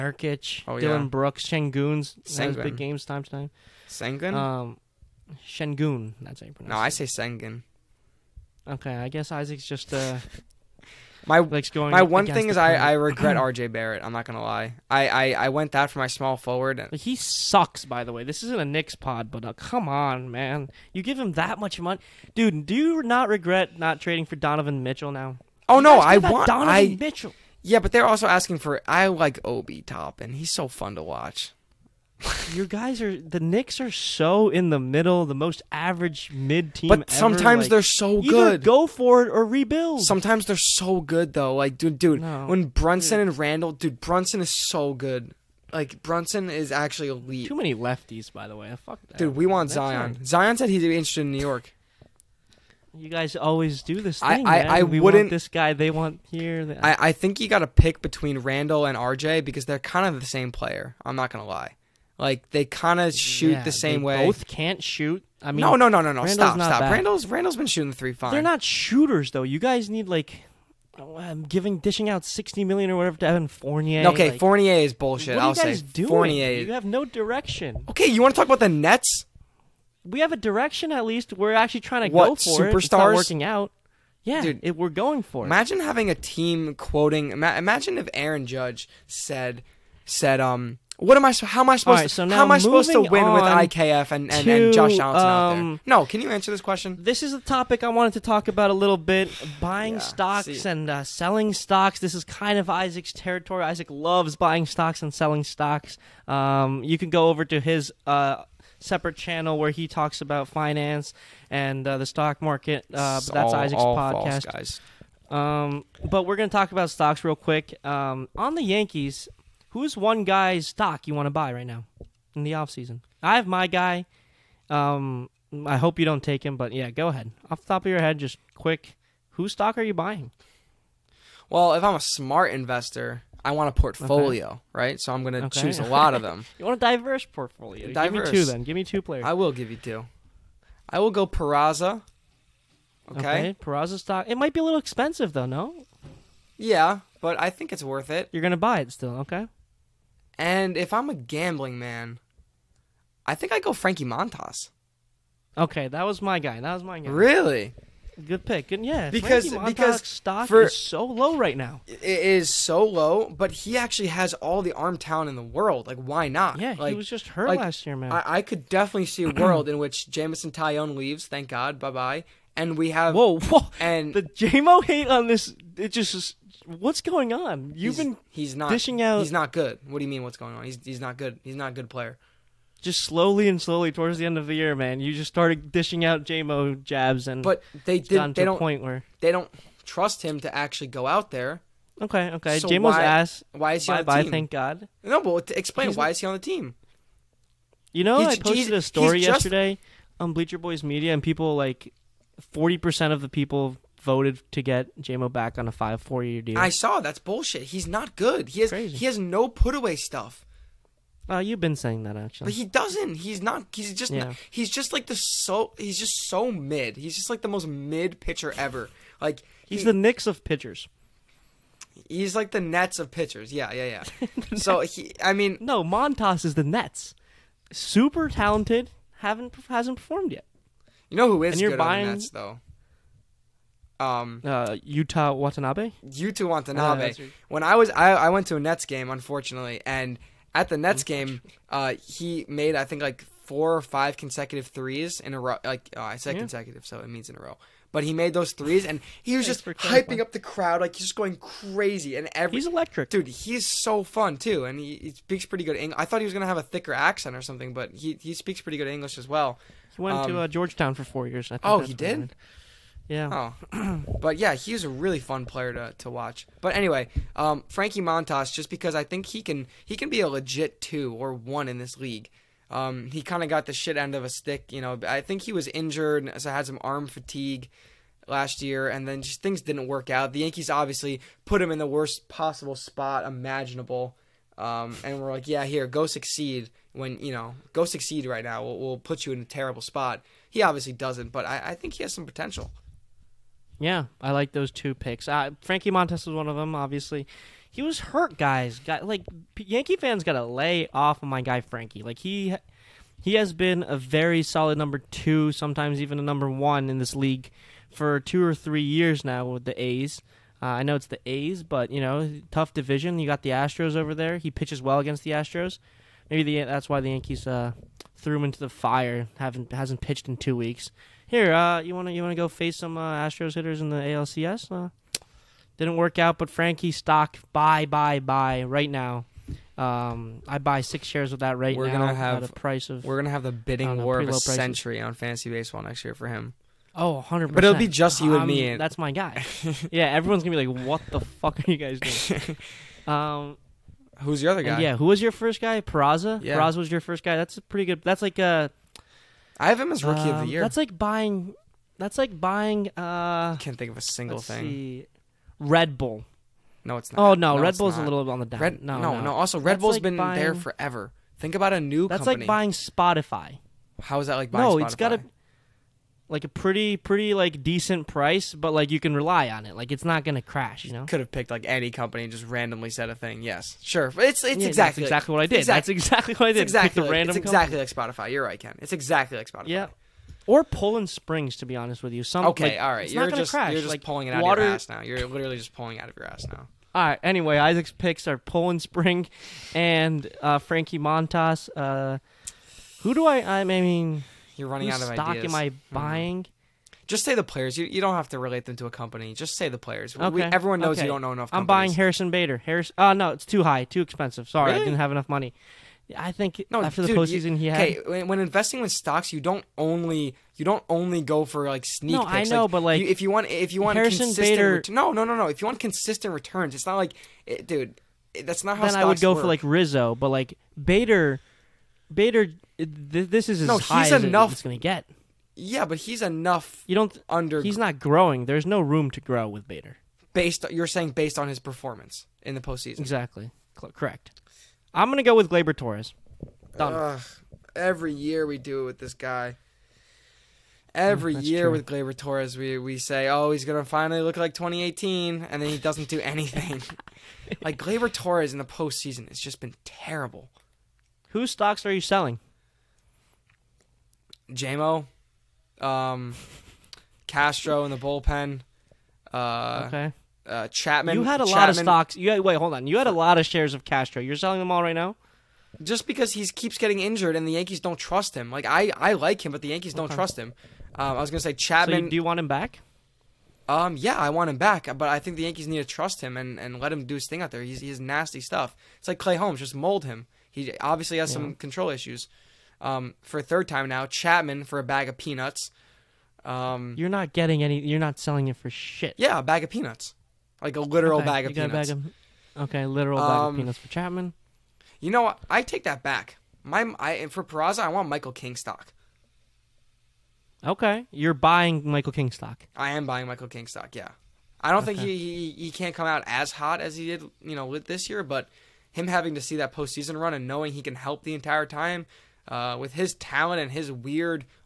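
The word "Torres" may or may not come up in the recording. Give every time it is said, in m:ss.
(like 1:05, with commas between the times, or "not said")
7:15, 7:22, 7:28.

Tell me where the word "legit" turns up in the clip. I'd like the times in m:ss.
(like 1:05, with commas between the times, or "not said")
4:30.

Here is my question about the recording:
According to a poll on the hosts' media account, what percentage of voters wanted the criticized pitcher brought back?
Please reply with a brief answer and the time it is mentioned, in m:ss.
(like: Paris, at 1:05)
40 percent, at 3:22.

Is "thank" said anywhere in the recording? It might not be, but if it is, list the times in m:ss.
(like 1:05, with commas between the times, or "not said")
2:51, 3:14.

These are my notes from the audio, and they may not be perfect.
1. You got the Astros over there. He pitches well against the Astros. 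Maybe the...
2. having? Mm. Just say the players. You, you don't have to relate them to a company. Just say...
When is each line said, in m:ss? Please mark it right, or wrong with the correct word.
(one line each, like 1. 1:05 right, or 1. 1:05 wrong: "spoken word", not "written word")
1. 5:13 right
2. 6:35 wrong: "buying", not "having".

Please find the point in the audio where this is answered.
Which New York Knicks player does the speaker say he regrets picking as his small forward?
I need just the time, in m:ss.
0:13.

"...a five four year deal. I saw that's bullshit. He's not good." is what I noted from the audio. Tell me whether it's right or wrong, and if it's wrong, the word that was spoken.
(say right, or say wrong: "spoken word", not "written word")
right.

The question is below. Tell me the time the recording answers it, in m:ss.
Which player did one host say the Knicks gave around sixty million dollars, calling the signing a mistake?
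1:13.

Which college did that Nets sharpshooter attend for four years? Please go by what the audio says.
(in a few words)
Georgetown.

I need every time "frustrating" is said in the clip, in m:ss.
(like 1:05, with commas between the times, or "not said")
not said.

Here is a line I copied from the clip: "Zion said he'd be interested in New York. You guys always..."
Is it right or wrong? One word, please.
right.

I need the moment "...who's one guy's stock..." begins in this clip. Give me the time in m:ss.
1:59.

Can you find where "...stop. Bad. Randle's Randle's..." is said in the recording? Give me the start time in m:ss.
1:06.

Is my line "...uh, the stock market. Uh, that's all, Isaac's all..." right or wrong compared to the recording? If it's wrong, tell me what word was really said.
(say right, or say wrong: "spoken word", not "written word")
right.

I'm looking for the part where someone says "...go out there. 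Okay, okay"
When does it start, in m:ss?
3:10.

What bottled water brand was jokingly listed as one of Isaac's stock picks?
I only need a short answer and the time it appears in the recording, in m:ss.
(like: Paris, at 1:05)
Poland Spring, at 6:28.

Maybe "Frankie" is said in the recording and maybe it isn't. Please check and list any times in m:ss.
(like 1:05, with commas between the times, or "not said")
2:33, 2:39, 4:27, 4:55, 5:01, 5:26, 6:30.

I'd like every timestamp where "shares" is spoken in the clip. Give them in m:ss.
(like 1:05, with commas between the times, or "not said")
5:31, 7:43.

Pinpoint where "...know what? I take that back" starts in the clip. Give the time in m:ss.
8:15.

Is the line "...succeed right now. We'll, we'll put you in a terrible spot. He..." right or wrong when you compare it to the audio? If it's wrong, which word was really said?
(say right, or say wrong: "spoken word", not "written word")
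right.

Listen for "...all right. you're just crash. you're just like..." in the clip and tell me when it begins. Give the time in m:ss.
6:22.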